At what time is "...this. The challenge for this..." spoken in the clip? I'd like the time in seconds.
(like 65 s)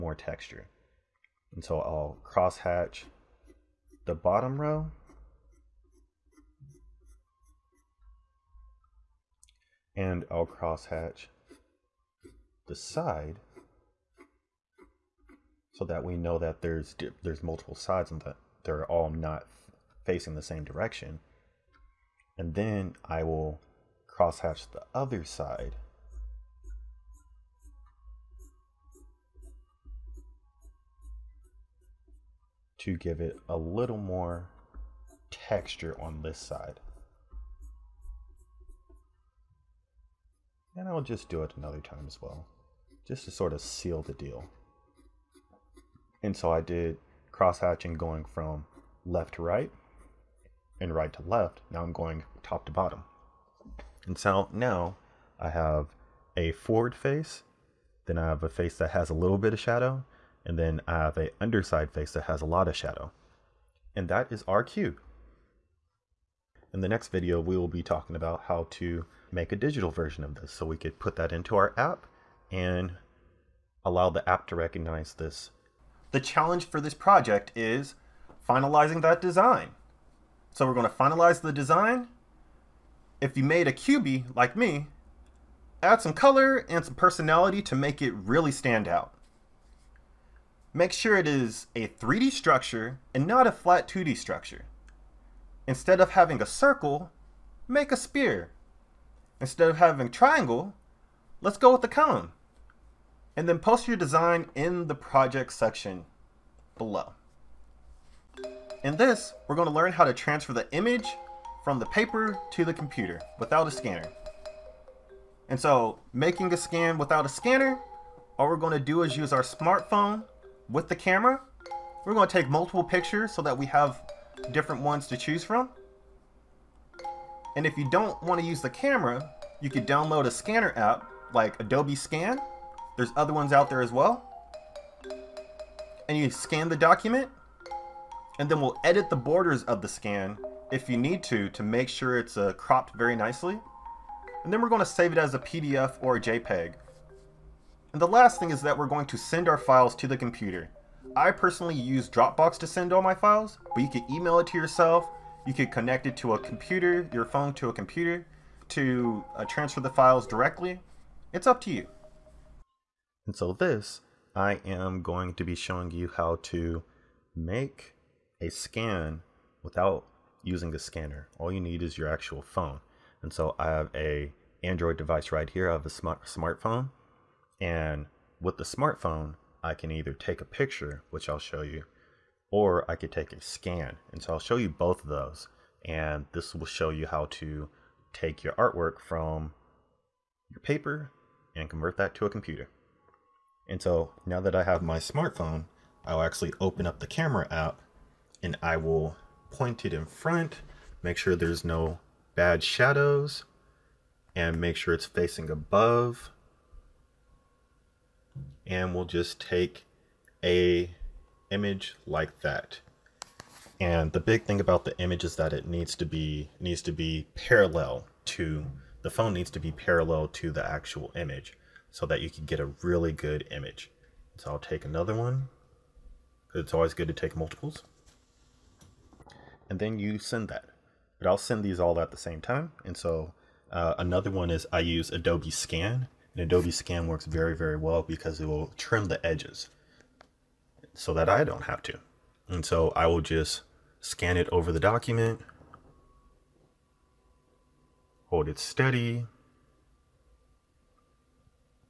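75 s.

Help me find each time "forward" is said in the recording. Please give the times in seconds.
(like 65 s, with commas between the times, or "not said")
56 s.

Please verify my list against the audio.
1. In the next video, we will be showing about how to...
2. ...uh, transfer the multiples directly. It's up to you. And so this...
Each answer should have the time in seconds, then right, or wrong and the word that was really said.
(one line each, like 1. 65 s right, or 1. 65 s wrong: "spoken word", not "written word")
1. 66 s wrong: "talking", not "showing"
2. 159 s wrong: "files", not "multiples".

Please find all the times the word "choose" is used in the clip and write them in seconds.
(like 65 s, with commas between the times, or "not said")
125 s.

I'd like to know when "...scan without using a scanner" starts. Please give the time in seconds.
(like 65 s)
168 s.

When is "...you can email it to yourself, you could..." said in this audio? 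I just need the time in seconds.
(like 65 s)
153 s.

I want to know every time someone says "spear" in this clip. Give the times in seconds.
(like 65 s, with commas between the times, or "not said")
97 s.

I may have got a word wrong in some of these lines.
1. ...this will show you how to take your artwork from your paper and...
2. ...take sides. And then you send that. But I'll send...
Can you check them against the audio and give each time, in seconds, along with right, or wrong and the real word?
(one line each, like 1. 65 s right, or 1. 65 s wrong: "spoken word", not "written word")
1. 186 s right
2. 227 s wrong: "multiples", not "sides".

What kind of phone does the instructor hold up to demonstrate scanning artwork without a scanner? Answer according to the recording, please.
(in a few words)
Android.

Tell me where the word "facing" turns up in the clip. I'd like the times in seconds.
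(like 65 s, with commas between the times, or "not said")
20 s, 205 s.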